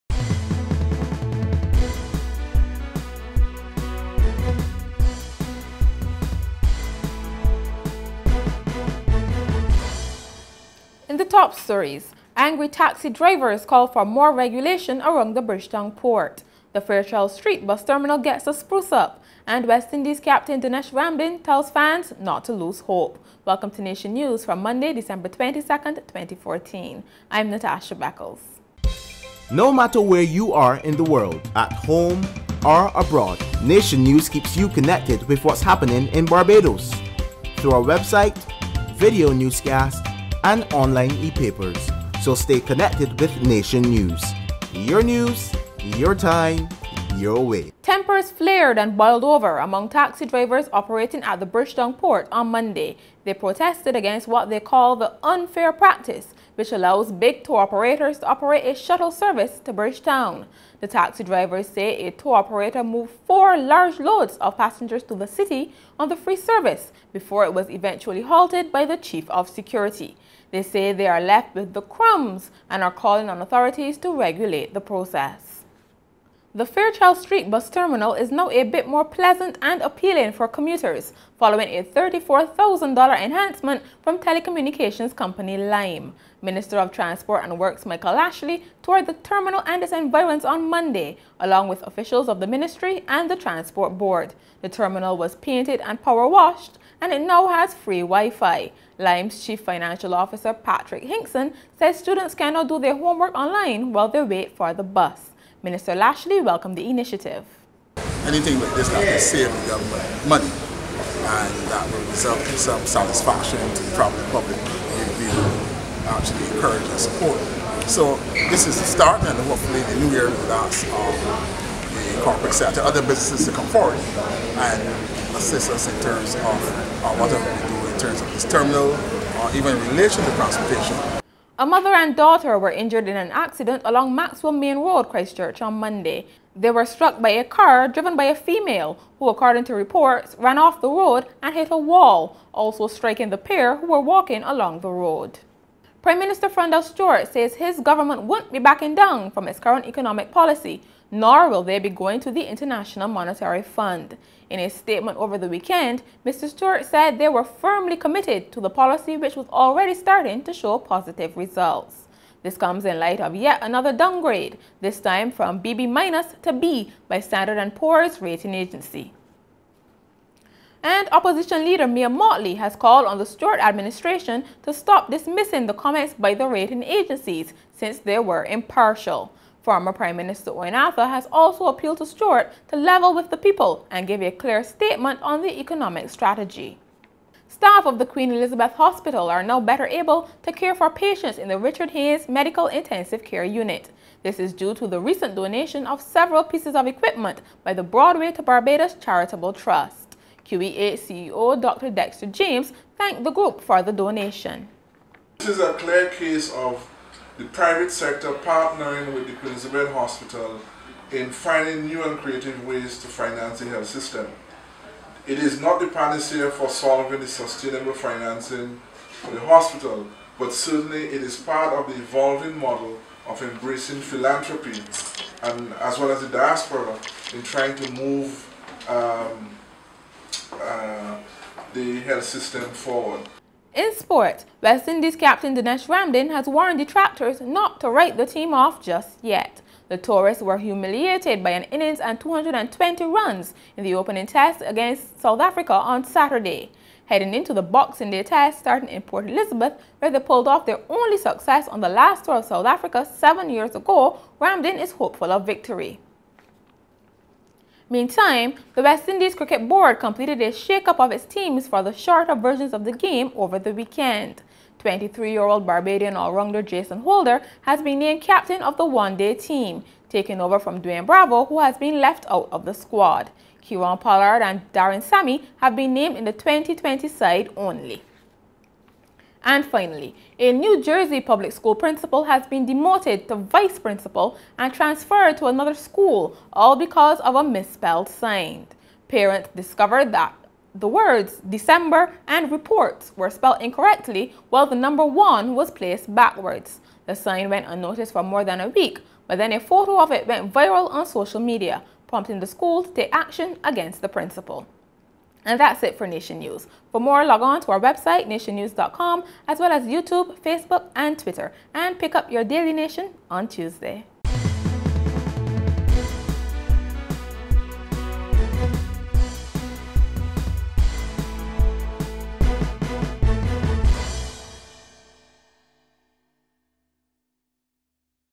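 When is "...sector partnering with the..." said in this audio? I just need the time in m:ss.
3:27.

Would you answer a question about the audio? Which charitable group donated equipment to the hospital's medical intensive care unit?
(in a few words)
Broadway to Barbados Charitable Trust.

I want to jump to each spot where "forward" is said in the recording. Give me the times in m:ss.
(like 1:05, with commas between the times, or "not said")
2:03, 3:52.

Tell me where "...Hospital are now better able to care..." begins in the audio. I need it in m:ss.
3:08.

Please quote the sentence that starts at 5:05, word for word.
And that's it for Nation News.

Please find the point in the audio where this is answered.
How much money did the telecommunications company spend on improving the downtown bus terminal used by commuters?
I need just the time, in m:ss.
1:21.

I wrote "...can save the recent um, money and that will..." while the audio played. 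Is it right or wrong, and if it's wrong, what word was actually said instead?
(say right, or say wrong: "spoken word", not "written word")
wrong: "government", not "recent".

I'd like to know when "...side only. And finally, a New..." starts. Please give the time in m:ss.
4:37.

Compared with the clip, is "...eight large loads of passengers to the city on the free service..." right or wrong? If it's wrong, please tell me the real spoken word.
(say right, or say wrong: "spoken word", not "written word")
wrong: "four", not "eight".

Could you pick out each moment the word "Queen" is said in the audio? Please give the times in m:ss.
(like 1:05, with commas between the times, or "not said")
3:08, 3:29.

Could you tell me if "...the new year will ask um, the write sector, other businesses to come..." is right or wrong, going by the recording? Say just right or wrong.
wrong.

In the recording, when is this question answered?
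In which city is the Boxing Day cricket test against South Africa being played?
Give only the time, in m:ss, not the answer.
4:09.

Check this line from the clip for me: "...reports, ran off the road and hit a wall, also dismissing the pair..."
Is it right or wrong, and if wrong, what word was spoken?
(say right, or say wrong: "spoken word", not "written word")
wrong: "striking", not "dismissing".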